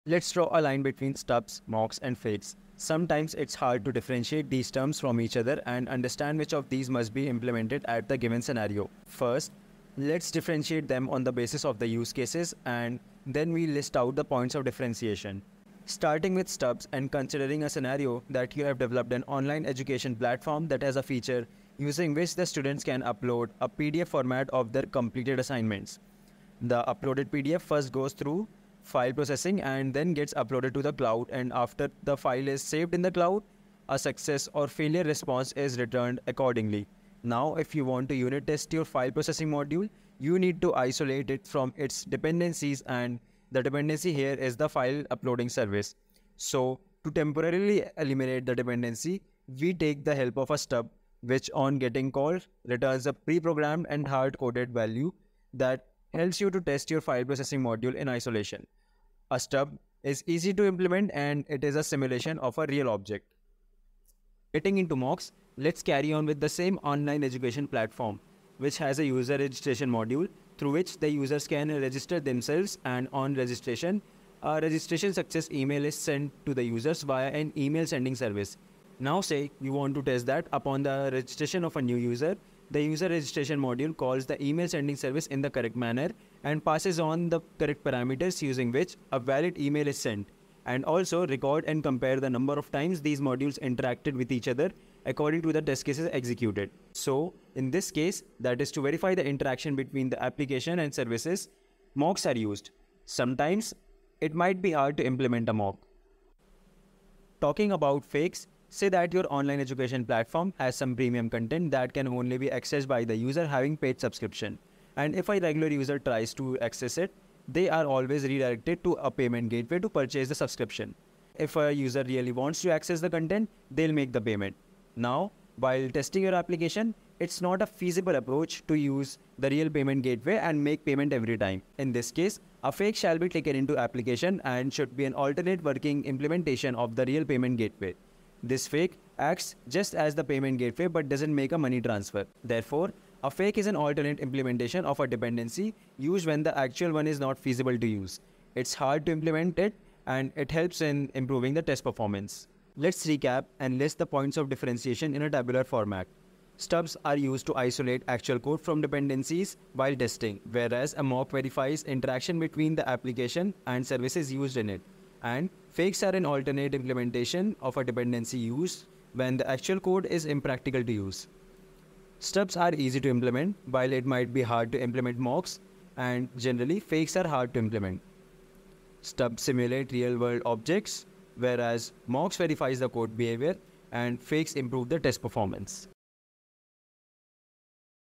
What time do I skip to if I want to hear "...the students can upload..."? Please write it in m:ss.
0:22.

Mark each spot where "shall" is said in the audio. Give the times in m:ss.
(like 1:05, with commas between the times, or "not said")
2:12.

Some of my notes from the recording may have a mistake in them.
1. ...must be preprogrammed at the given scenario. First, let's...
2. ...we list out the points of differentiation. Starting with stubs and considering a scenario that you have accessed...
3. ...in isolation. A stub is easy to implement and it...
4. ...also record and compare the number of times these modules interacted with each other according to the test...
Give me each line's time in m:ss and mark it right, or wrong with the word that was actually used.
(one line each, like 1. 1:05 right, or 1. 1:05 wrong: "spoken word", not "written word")
1. 0:06 wrong: "implemented", not "preprogrammed"
2. 0:13 wrong: "developed", not "accessed"
3. 0:57 right
4. 1:30 right.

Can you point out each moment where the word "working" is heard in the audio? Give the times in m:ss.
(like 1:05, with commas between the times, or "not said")
2:15.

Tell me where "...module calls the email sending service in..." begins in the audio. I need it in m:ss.
1:23.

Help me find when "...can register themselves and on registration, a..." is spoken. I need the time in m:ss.
1:11.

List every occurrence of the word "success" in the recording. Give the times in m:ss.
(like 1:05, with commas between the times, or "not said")
0:33, 1:15.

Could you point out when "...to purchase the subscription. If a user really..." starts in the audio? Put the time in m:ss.
1:59.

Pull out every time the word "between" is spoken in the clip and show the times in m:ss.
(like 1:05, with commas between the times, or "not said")
0:00, 1:39, 2:42.